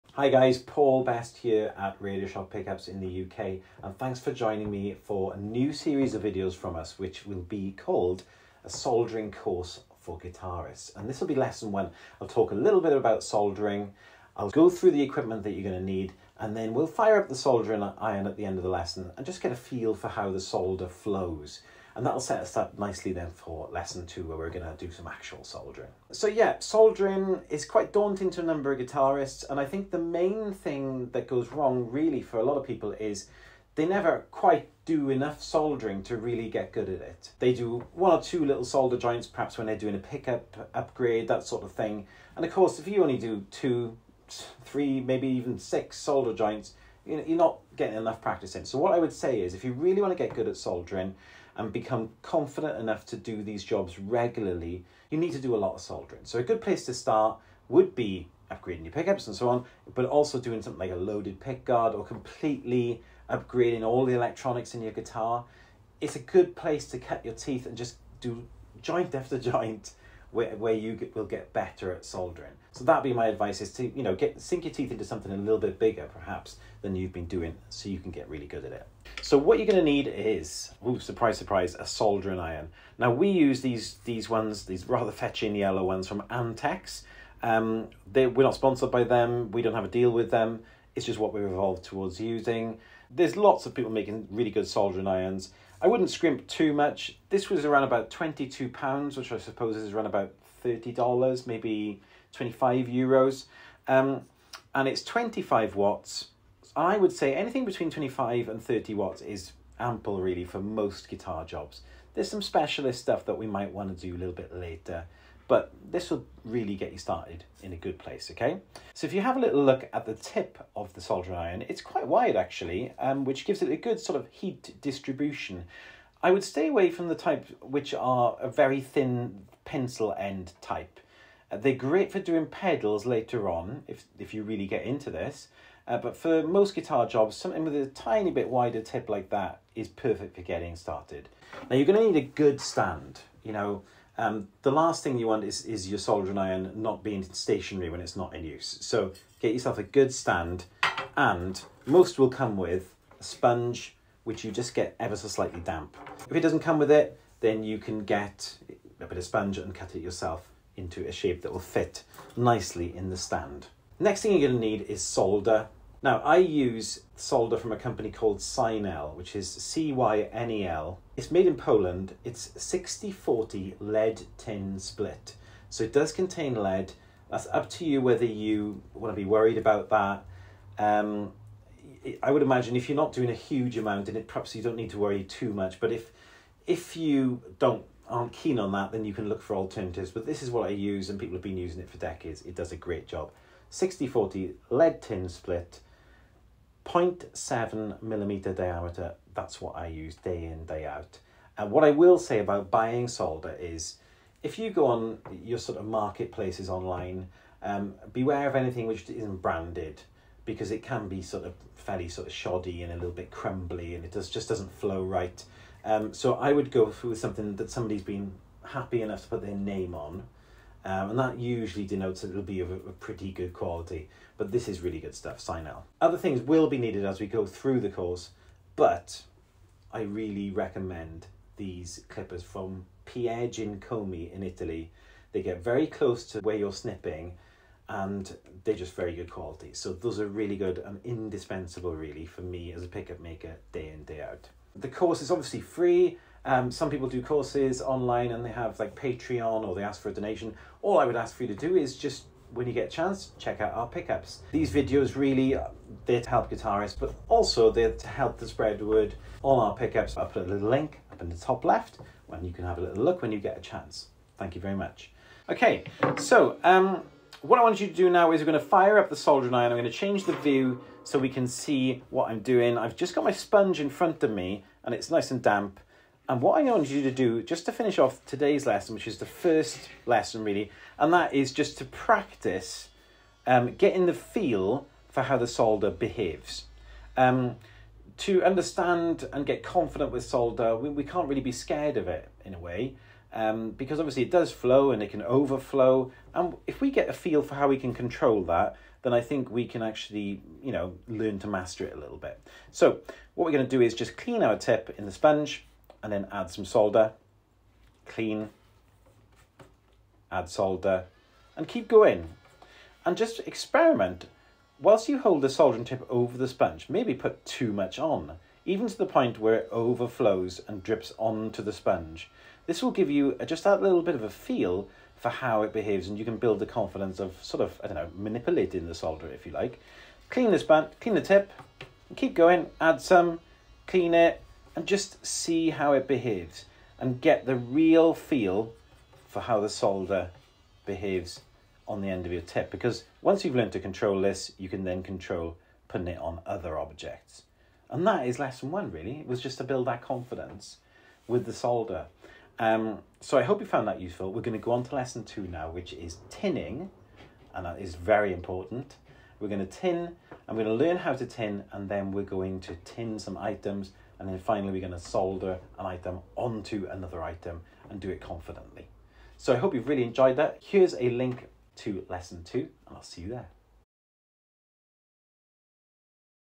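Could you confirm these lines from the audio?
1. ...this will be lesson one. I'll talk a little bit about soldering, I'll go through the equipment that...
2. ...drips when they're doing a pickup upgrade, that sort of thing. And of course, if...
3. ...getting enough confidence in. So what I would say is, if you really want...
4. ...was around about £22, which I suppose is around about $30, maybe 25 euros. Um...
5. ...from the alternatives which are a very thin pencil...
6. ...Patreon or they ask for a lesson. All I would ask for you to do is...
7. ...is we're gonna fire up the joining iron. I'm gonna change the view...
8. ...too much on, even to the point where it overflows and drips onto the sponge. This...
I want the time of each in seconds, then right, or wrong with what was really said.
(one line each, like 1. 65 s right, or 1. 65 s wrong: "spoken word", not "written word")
1. 11 s right
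2. 39 s wrong: "perhaps", not "drips"
3. 47 s wrong: "practice", not "confidence"
4. 97 s right
5. 126 s wrong: "types", not "alternatives"
6. 248 s wrong: "donation", not "lesson"
7. 268 s wrong: "soldering", not "joining"
8. 317 s right.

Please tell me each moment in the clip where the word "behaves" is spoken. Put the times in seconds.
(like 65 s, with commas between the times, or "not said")
285 s, 325 s, 336 s, 340 s.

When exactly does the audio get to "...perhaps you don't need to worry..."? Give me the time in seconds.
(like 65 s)
184 s.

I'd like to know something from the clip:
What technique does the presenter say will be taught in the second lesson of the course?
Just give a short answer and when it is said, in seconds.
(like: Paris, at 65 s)
Tinning, at 356 s.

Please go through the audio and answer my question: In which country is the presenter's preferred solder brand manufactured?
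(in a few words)
Poland.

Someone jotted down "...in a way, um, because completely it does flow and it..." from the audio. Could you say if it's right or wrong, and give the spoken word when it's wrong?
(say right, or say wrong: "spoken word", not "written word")
wrong: "obviously", not "completely".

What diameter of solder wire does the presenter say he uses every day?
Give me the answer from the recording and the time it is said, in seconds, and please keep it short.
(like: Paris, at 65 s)
0.7 millimeter, at 196 s.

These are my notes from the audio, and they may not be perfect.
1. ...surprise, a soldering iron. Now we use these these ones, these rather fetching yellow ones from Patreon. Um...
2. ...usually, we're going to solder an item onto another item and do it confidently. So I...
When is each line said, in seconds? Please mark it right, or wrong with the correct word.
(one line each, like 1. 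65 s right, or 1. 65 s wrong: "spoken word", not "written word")
1. 81 s wrong: "Antex", not "Patreon"
2. 364 s wrong: "finally", not "usually".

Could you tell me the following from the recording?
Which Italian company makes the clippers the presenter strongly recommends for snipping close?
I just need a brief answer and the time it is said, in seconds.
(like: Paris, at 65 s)
Piergiacomi, at 233 s.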